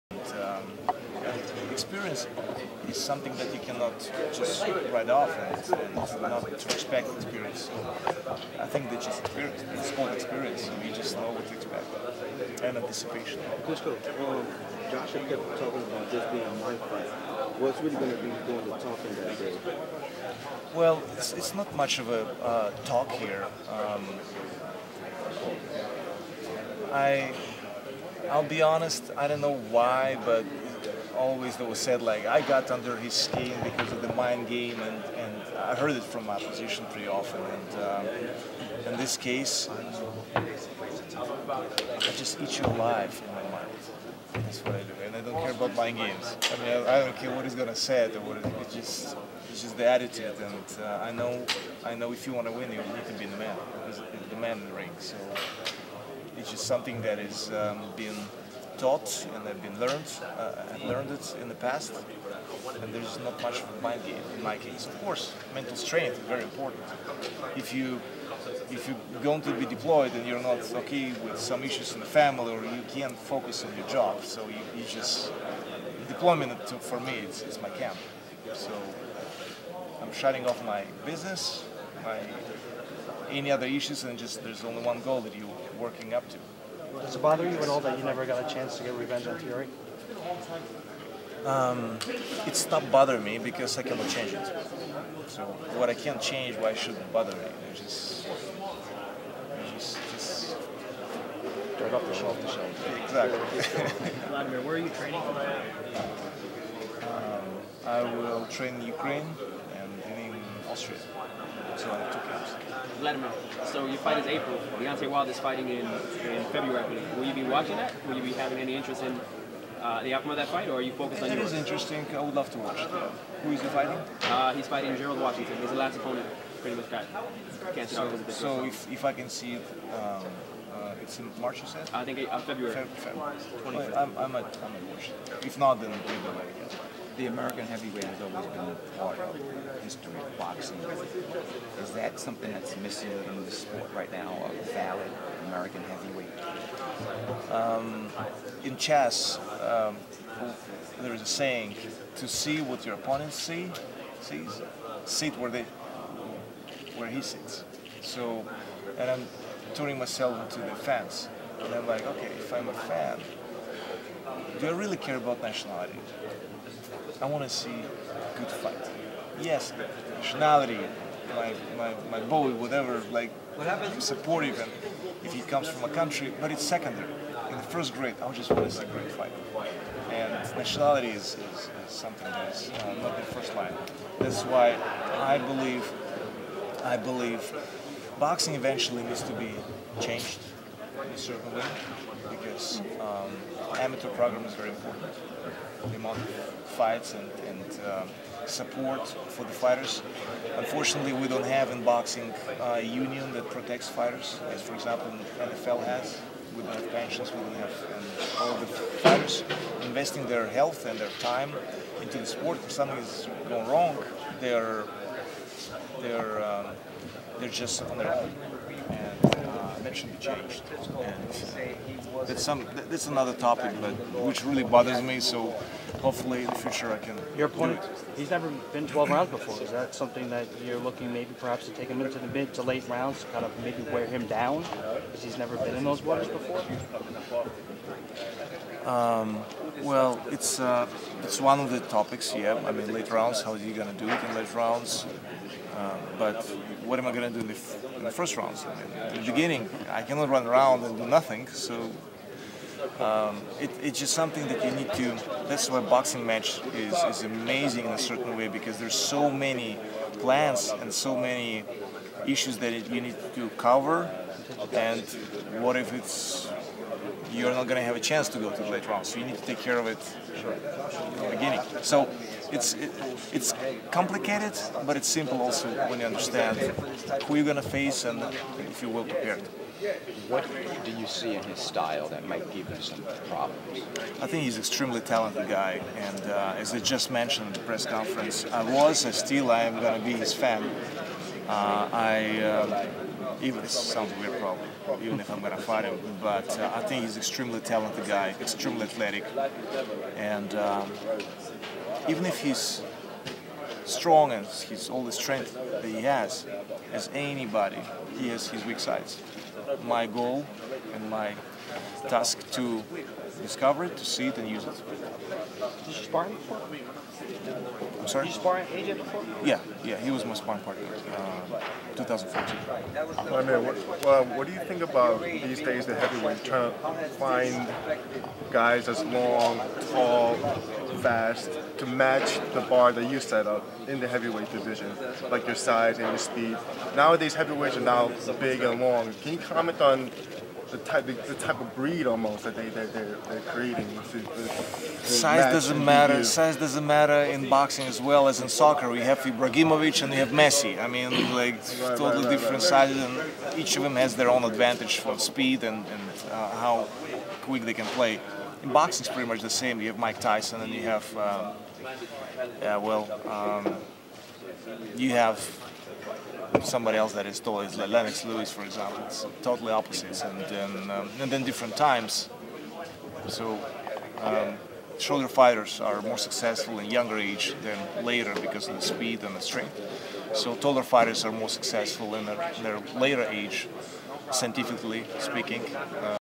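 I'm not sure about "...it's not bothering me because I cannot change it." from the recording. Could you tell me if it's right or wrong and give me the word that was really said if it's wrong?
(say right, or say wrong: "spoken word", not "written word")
right.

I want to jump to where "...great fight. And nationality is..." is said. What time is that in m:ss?
2:58.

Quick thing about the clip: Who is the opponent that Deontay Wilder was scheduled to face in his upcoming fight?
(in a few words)
Gerald Washington.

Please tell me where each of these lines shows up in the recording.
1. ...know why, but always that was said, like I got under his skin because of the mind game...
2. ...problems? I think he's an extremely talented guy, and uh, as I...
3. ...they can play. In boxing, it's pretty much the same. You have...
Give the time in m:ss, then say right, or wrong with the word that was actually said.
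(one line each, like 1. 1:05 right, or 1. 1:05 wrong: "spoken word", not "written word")
1. 0:29 right
2. 4:43 right
3. 5:57 right.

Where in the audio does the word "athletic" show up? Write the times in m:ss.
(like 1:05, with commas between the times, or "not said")
4:58.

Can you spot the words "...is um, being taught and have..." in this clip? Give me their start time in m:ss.
0:57.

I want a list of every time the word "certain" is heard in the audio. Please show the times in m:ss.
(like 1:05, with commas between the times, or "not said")
3:11, 4:17.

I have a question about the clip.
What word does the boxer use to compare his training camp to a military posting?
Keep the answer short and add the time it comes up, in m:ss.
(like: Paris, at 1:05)
Deployment, at 1:16.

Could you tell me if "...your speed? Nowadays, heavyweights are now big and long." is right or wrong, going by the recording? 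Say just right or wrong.
right.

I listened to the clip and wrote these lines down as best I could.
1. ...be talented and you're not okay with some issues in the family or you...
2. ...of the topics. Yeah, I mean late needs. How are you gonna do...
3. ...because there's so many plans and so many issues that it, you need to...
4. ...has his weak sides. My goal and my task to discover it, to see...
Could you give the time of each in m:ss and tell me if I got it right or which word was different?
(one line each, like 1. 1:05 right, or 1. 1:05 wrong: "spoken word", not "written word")
1. 1:09 wrong: "deployed", not "talented"
2. 4:01 wrong: "rounds", not "needs"
3. 4:18 right
4. 5:08 right.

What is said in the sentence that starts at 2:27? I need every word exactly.
Um, in chess, um, there is a saying, to see what your opponent see, sees, sit where, they, where he sits.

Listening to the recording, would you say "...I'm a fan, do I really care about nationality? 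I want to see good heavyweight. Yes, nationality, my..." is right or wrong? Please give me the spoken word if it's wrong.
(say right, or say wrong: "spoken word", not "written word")
wrong: "fight", not "heavyweight".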